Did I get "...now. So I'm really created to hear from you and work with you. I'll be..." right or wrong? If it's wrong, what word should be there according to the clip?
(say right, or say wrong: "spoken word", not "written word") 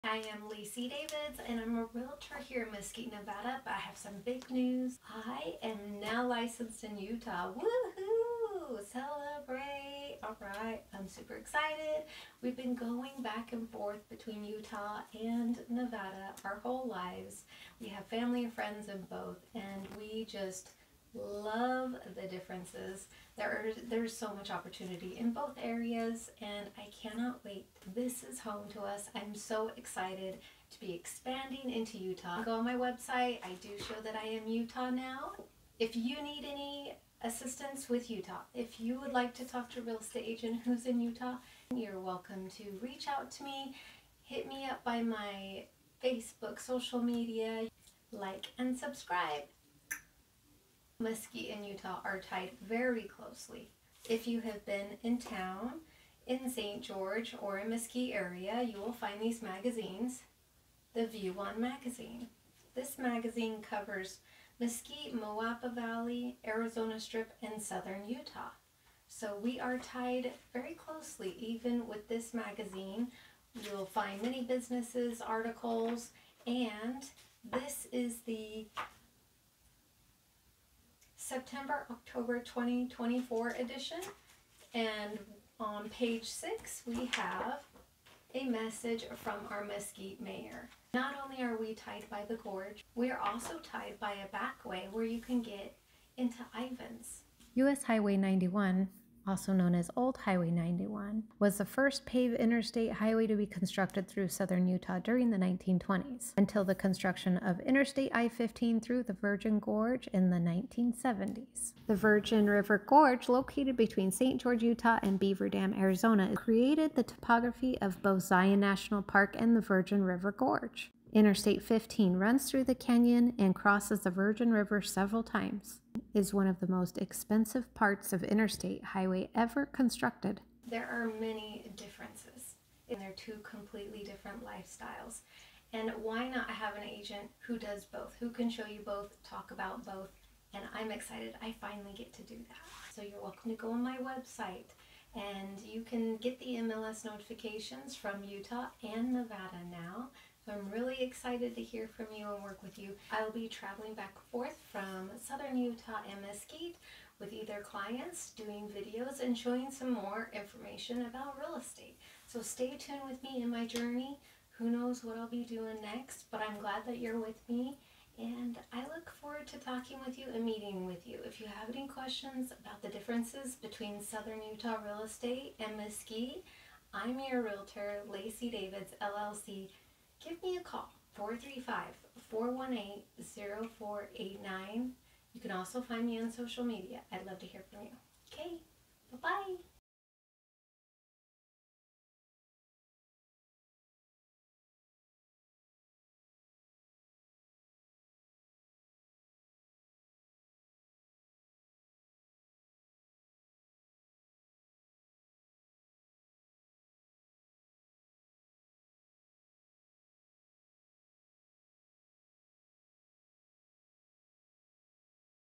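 wrong: "excited", not "created".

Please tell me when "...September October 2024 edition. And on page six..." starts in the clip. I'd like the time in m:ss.
1:21.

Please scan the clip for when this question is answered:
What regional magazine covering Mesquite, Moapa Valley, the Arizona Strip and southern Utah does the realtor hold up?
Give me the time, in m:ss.
1:00.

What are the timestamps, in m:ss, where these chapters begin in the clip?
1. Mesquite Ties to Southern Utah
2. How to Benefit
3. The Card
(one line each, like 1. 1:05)
1. 0:51
2. 2:23
3. 3:10.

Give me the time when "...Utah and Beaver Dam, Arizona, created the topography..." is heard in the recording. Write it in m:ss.
1:54.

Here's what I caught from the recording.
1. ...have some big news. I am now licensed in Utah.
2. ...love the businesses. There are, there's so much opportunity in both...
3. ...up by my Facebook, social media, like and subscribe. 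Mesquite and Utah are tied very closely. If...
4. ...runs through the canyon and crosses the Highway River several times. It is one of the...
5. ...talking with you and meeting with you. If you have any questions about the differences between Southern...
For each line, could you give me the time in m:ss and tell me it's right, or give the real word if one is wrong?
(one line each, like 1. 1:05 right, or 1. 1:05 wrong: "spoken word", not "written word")
1. 0:03 right
2. 0:21 wrong: "differences", not "businesses"
3. 0:44 right
4. 2:02 wrong: "Virgin", not "Highway"
5. 2:49 right.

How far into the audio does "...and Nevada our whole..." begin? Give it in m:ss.
0:15.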